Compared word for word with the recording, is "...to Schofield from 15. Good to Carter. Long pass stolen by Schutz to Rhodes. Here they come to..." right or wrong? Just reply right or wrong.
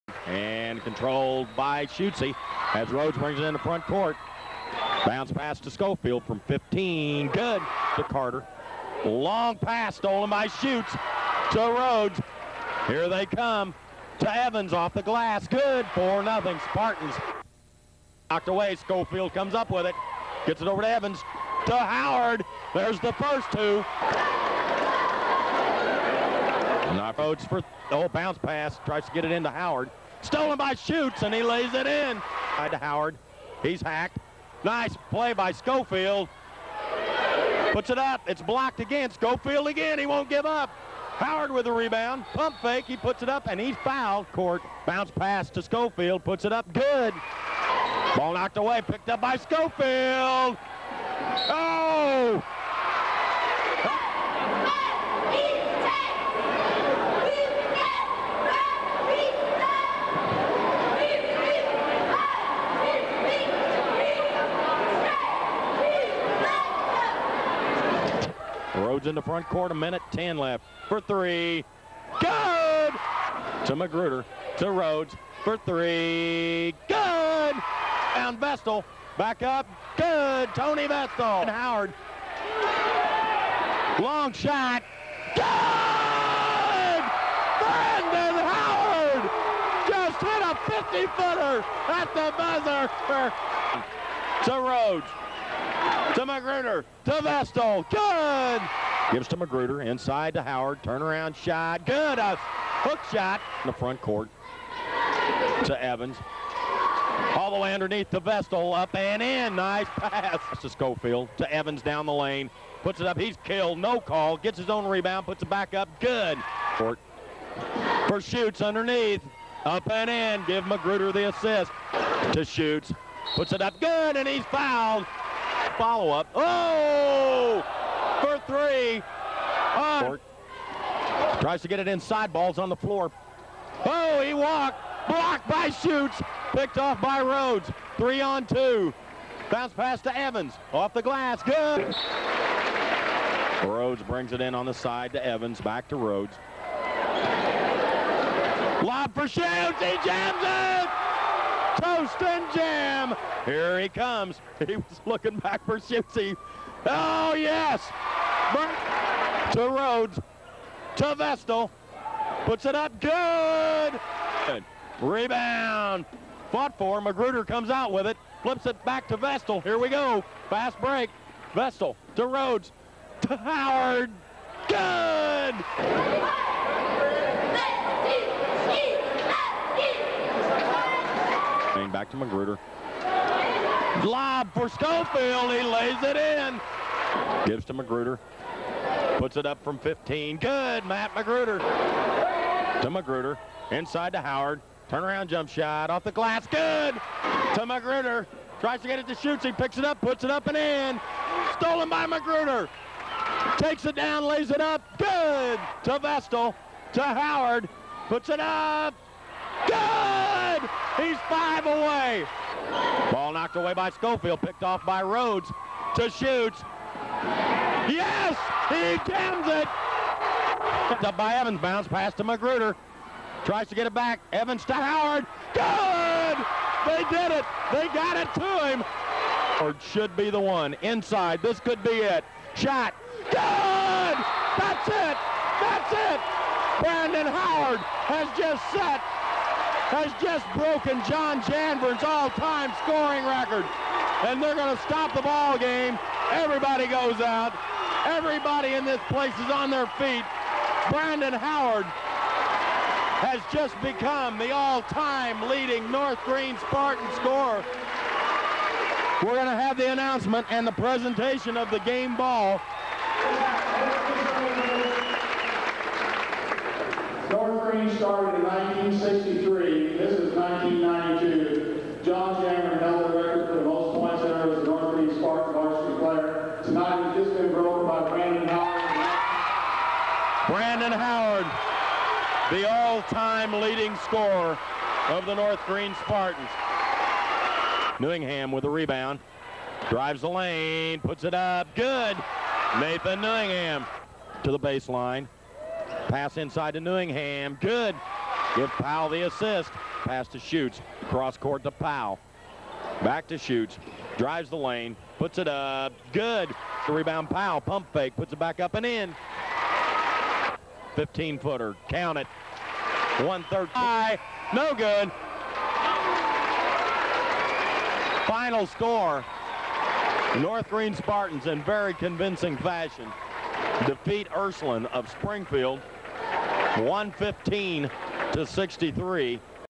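right.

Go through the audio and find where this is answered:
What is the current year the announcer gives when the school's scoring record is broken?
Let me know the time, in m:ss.
4:30.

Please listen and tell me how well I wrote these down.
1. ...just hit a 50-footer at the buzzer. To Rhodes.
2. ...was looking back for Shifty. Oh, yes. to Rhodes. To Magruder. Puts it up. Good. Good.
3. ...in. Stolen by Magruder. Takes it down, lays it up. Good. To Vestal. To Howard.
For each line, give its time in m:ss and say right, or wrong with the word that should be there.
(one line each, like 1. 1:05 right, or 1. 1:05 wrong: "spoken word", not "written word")
1. 1:29 right
2. 2:34 wrong: "Vestal", not "Magruder"
3. 3:20 right.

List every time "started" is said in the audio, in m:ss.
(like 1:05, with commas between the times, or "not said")
4:27.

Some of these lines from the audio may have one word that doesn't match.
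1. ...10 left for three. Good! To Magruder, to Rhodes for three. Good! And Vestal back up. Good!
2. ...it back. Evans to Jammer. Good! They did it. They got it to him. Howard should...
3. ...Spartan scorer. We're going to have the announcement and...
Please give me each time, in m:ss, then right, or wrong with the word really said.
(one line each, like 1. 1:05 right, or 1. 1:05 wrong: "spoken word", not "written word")
1. 1:10 right
2. 3:43 wrong: "Howard", not "Jammer"
3. 4:16 right.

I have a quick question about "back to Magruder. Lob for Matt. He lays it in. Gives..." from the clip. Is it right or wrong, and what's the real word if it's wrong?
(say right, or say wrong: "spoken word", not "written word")
wrong: "Schofield", not "Matt".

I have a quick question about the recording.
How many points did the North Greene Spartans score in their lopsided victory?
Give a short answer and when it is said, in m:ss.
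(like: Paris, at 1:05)
115, at 5:26.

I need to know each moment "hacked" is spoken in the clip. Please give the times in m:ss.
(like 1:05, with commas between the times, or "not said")
0:33.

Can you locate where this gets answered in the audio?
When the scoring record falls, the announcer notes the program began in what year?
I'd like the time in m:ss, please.
4:28.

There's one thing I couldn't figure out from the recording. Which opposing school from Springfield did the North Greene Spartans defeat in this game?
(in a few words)
Ursuline.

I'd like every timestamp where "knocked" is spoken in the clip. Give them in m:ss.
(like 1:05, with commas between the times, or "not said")
0:18, 0:48, 3:33.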